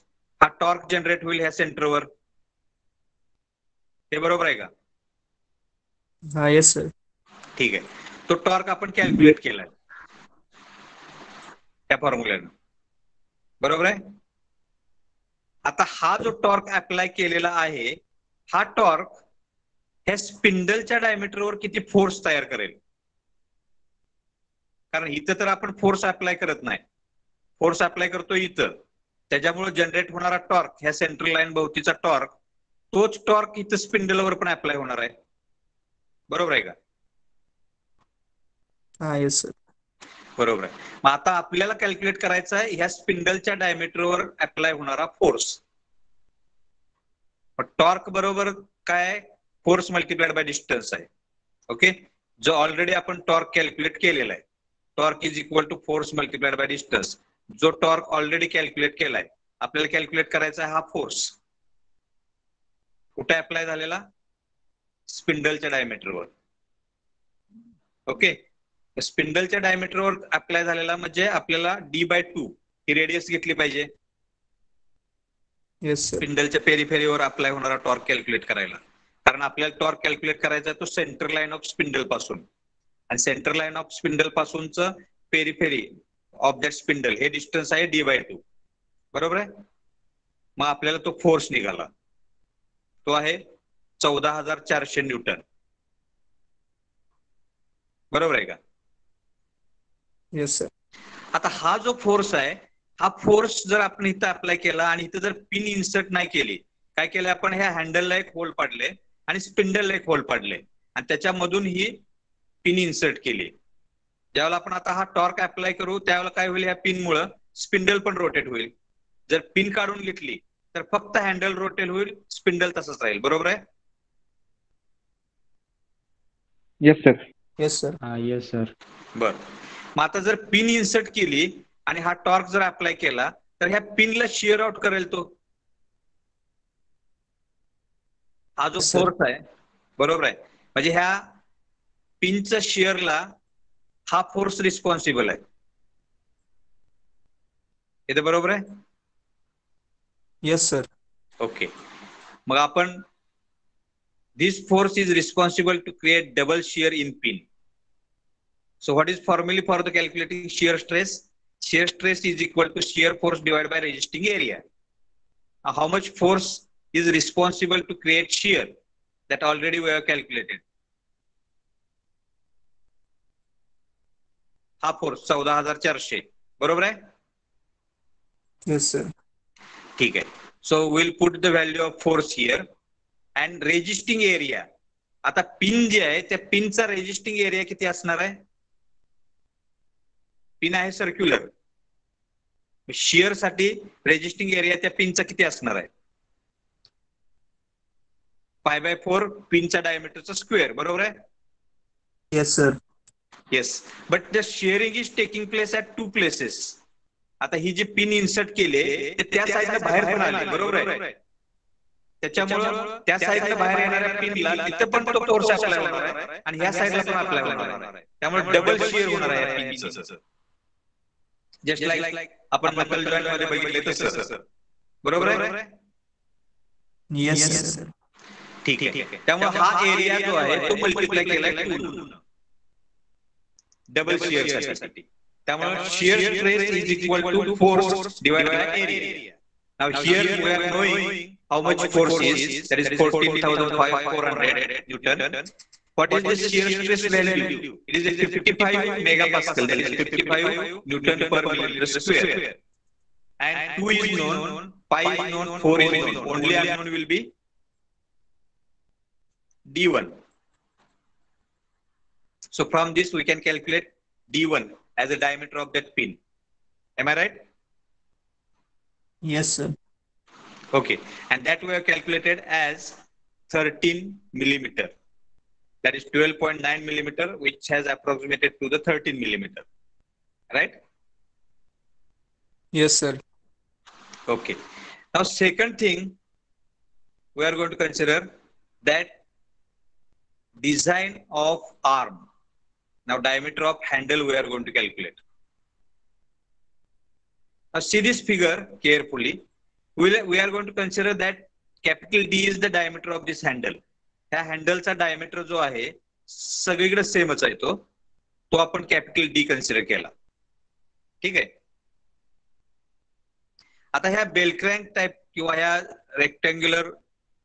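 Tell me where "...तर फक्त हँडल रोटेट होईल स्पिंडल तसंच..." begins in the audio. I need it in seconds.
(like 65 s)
120 s.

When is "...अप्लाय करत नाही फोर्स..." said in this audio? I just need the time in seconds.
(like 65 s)
26 s.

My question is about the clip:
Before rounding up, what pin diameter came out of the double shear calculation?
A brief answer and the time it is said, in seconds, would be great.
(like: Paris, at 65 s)
12.9 millimeter, at 276 s.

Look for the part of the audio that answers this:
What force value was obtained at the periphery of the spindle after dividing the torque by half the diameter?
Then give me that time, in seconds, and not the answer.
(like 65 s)
94 s.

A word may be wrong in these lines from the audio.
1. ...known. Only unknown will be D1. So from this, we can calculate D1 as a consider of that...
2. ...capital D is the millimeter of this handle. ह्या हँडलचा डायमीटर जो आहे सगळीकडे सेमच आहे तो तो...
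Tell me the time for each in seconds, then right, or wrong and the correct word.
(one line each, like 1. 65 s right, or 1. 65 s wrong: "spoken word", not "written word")
1. 255 s wrong: "diameter", not "consider"
2. 301 s wrong: "diameter", not "millimeter".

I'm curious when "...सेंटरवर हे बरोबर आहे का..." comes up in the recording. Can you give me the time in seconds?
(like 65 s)
1 s.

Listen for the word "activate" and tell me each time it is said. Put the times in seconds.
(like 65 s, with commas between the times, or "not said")
not said.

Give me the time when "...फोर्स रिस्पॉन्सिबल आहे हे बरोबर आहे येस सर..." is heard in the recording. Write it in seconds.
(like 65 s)
144 s.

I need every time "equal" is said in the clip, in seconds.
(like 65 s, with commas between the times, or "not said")
162 s, 236 s.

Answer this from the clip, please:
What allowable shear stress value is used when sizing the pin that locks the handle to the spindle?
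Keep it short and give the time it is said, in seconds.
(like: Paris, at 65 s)
55 megapascal, at 248 s.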